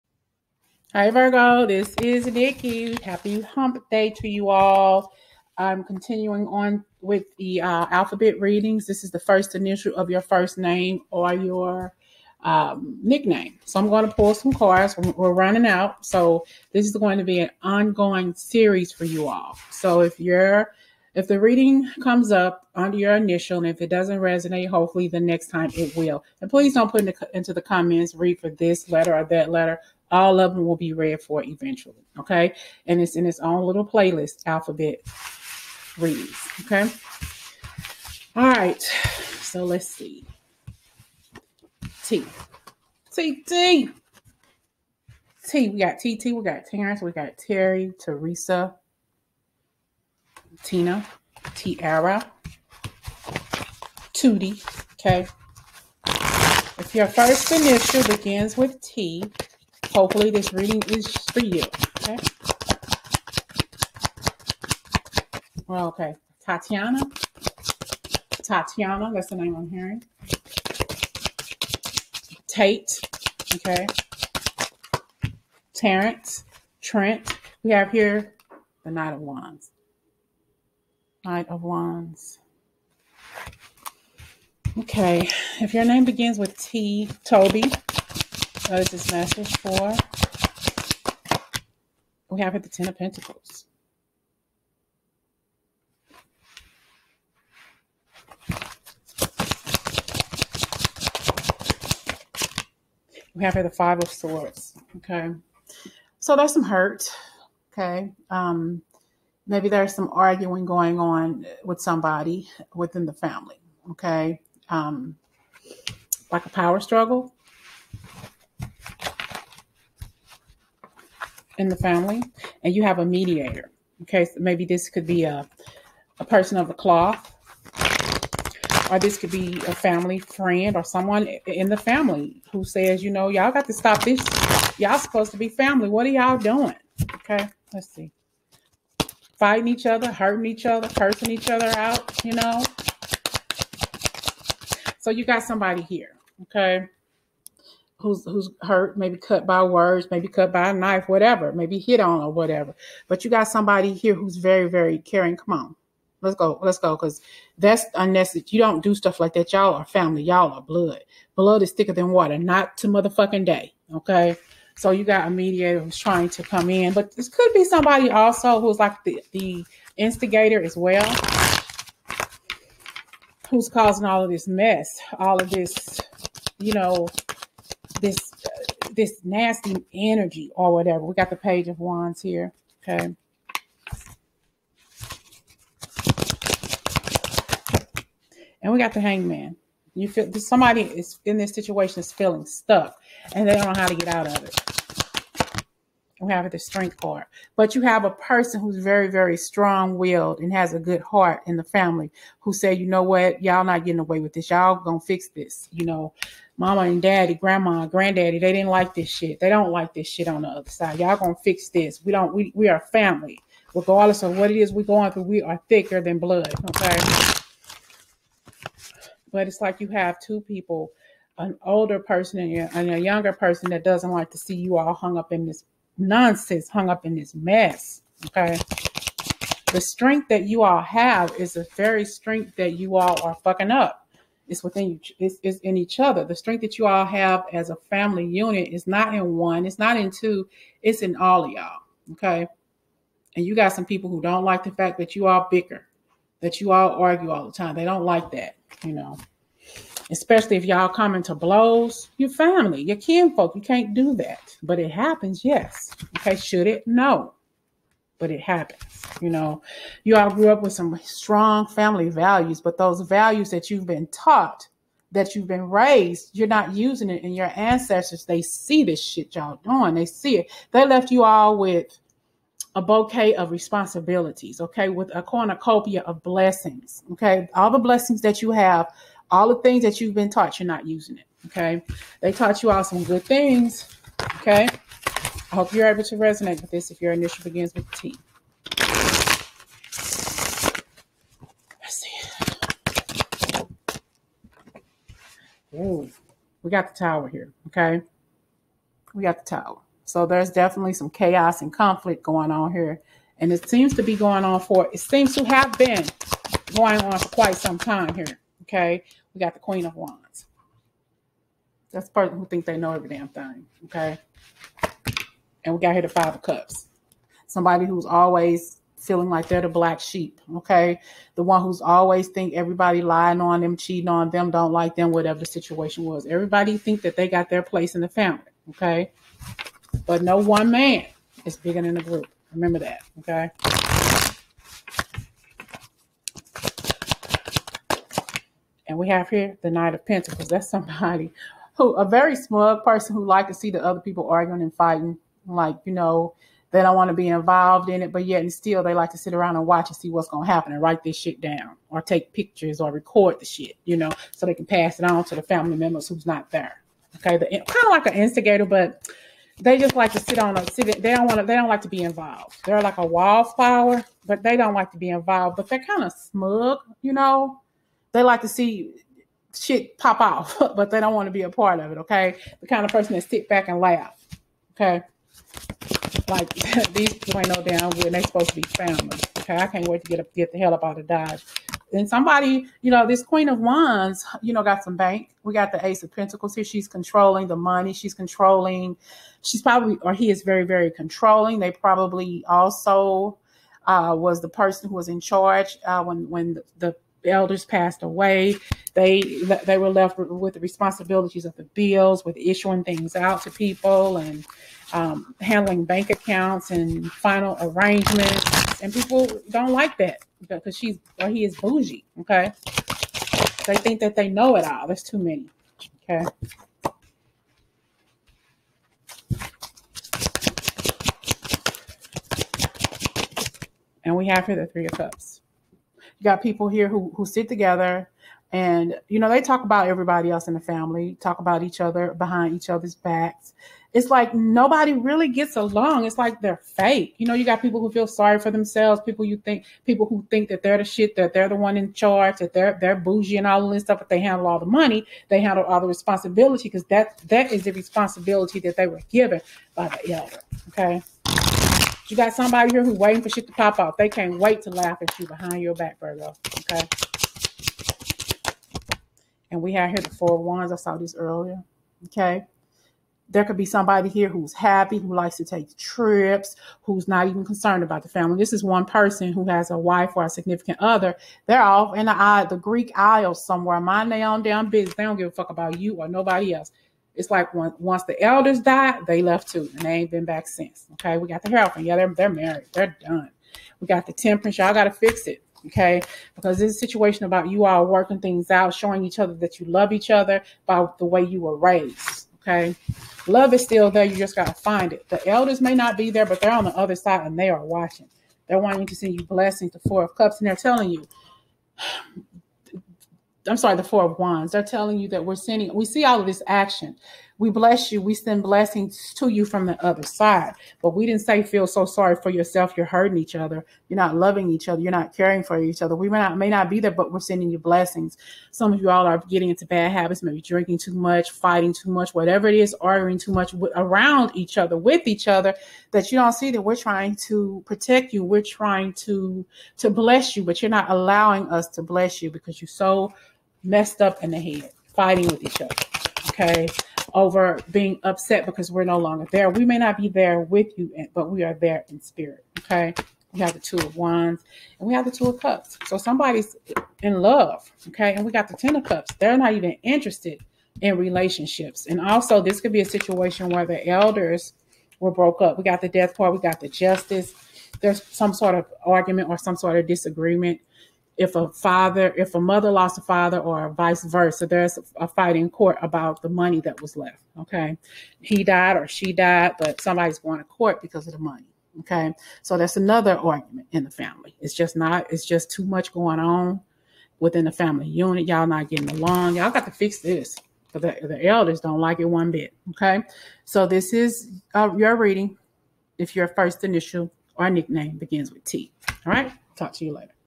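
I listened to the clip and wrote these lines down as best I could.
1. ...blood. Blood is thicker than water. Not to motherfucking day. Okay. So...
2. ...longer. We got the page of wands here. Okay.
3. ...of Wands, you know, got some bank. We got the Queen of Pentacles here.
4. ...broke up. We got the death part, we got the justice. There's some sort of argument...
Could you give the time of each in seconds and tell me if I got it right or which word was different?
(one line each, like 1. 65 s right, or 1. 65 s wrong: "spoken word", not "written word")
1. 160 s right
2. 180 s wrong: "whatever", not "longer"
3. 383 s wrong: "Ace", not "Queen"
4. 555 s right.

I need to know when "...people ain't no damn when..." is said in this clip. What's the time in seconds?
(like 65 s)
377 s.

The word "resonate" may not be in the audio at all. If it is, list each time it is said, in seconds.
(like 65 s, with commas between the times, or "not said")
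24 s, 286 s.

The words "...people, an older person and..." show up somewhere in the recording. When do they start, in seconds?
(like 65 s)
220 s.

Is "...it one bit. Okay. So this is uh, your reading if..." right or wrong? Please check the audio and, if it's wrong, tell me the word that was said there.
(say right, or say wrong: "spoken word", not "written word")
right.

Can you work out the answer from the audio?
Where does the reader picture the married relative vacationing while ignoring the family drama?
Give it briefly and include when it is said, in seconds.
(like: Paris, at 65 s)
The Greek Isles, at 472 s.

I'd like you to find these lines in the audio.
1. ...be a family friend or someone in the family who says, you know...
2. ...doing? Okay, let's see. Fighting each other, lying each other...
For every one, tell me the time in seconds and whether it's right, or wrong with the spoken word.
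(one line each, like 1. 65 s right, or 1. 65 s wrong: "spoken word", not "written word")
1. 129 s right
2. 136 s wrong: "hurting", not "lying".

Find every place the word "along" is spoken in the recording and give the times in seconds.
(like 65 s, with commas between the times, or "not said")
435 s, 578 s.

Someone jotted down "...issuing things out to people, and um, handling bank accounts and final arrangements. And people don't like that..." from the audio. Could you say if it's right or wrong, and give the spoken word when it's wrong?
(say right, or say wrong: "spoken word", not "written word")
right.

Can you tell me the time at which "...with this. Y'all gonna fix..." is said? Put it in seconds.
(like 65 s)
204 s.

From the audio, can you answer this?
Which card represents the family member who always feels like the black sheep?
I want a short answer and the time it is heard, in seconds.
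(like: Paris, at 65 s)
Five of Cups, at 316 s.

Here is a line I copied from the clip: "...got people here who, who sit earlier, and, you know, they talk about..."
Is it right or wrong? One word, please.
wrong.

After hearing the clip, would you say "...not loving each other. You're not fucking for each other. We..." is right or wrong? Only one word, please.
wrong.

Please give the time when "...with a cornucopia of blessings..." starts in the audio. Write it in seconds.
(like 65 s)
274 s.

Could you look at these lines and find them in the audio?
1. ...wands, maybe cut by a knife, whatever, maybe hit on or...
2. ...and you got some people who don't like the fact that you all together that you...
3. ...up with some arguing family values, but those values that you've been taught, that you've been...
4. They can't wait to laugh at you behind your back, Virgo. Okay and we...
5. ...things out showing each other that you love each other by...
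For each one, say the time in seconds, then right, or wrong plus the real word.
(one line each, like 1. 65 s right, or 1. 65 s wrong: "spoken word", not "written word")
1. 149 s wrong: "words", not "wands"
2. 243 s wrong: "bicker", not "together"
3. 260 s wrong: "strong", not "arguing"
4. 453 s right
5. 488 s right.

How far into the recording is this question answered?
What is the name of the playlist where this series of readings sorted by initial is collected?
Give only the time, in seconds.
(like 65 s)
34 s.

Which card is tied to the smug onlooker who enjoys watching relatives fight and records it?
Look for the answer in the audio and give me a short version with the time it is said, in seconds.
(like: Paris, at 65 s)
Knight of Pentacles, at 339 s.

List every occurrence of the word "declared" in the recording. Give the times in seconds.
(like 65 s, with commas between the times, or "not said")
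not said.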